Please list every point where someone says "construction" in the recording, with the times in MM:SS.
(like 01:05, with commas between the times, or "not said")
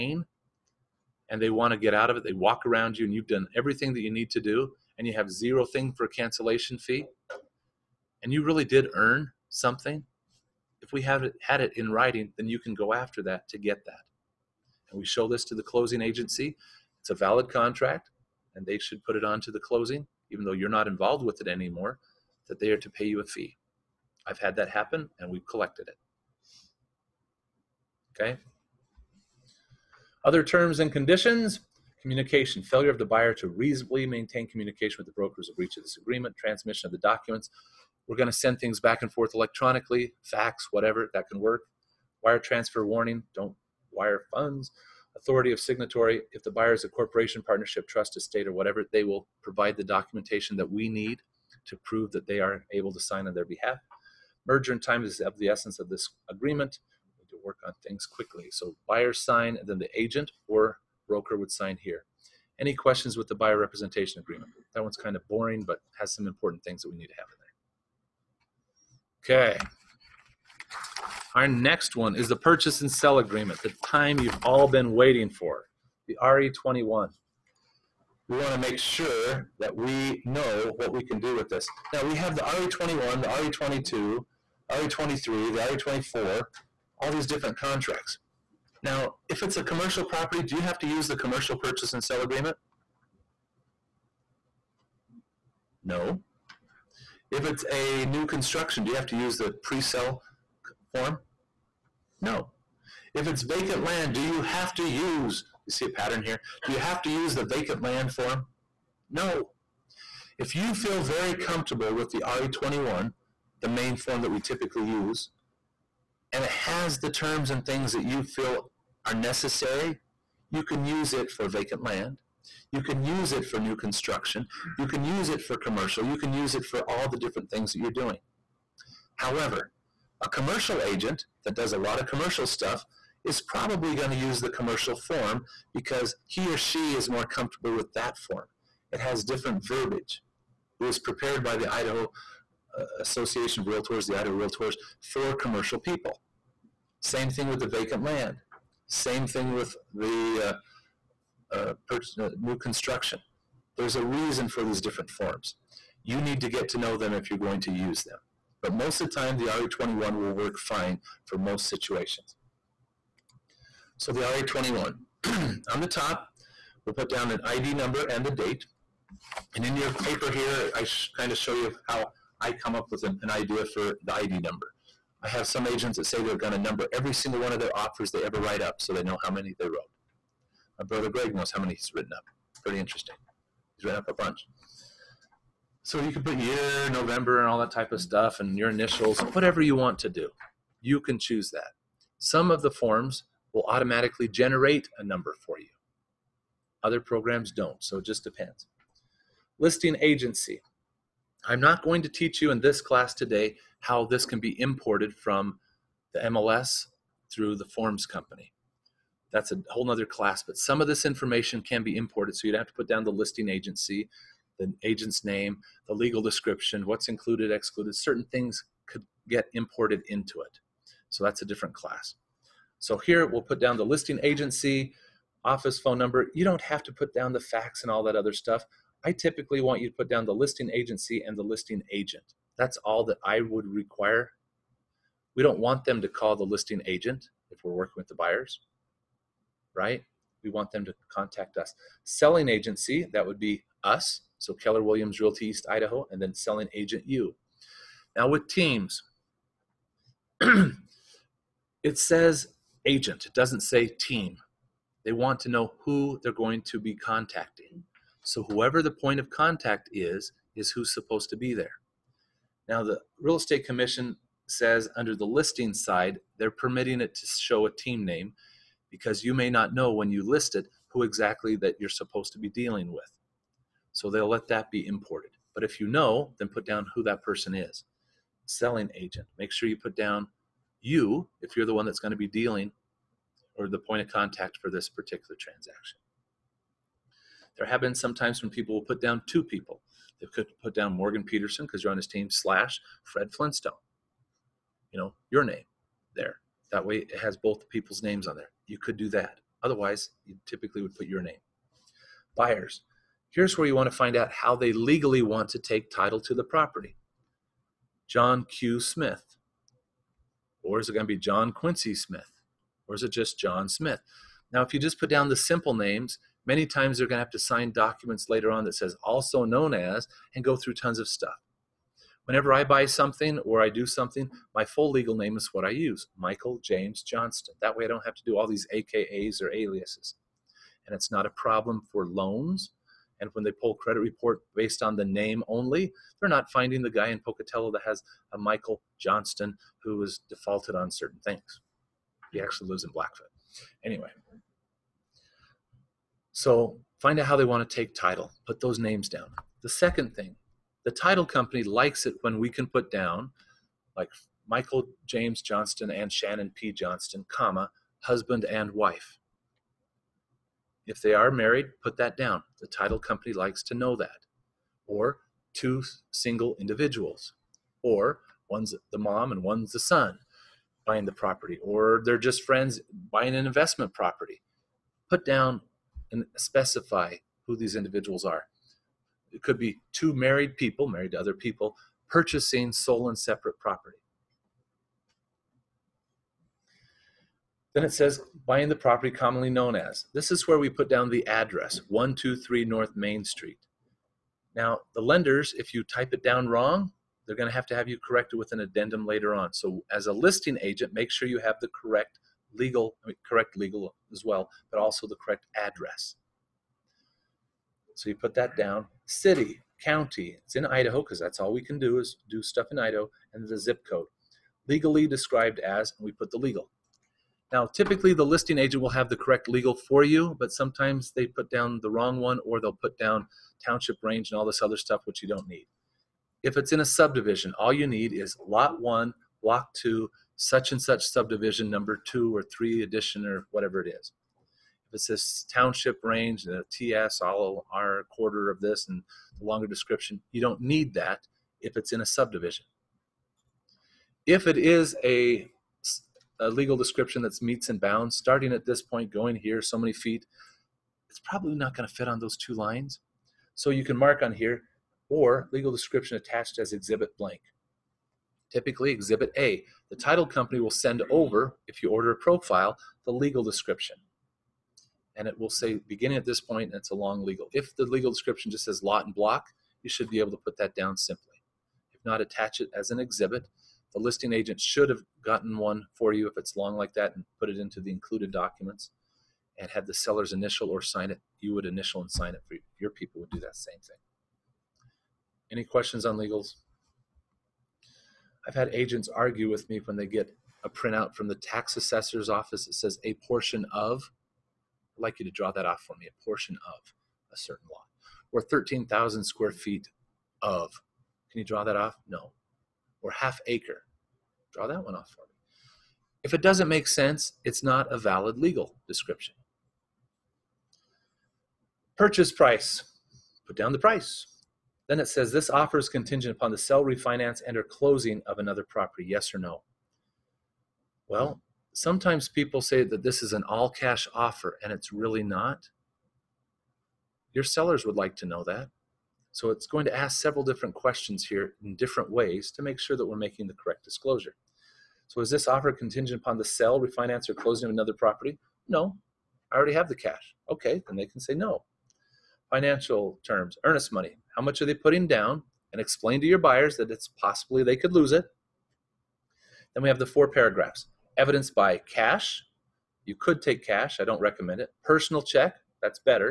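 01:38, 02:03, 02:32.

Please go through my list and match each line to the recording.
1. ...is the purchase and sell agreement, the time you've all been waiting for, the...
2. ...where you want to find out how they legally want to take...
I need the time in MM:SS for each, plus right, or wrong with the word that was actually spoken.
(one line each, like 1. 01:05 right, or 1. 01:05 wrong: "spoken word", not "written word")
1. 01:12 right
2. 05:03 right.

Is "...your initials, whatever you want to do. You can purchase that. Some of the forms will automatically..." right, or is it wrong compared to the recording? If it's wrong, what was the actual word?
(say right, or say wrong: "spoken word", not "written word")
wrong: "choose", not "purchase".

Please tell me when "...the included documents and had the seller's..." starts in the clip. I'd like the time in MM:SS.
07:57.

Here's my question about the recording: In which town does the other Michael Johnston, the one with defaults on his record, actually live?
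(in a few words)
Blackfoot.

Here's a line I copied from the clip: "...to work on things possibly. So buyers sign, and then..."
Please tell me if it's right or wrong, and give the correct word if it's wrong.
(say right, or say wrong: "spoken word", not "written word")
wrong: "quickly", not "possibly".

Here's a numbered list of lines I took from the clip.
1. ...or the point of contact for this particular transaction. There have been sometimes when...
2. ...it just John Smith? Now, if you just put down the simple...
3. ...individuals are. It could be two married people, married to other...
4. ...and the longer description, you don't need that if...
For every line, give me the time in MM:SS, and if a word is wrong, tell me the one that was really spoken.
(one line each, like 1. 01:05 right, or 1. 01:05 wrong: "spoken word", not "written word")
1. 04:43 right
2. 05:13 right
3. 06:17 right
4. 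07:18 right.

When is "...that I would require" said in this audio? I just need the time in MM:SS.
03:53.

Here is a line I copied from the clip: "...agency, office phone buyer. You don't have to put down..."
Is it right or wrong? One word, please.
wrong.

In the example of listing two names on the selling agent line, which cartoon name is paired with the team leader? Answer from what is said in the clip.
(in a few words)
Fred Flintstone.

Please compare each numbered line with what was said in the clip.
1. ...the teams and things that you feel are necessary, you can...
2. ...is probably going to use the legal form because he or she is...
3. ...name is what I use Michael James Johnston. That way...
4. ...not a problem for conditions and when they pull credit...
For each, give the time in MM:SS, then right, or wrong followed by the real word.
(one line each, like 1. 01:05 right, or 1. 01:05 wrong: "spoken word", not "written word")
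1. 01:56 wrong: "terms", not "teams"
2. 02:13 wrong: "commercial", not "legal"
3. 05:25 right
4. 05:31 wrong: "loans", not "conditions".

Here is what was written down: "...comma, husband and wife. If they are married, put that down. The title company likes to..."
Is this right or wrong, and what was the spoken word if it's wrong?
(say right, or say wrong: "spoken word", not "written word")
right.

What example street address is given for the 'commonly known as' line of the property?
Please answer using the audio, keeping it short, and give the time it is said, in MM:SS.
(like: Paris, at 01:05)
123 North Main Street, at 06:31.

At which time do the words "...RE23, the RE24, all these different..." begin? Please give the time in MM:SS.
01:24.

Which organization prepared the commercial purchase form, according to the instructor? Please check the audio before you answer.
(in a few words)
Idaho Realtors.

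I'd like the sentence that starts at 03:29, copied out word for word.
That's a whole nother class, but some of this information can be imported.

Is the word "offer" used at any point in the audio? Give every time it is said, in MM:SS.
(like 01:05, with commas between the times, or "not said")
02:57, 08:35, 08:44, 08:55.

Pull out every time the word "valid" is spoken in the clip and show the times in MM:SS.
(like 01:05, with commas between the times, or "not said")
00:17, 08:27.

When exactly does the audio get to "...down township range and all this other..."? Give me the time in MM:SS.
07:02.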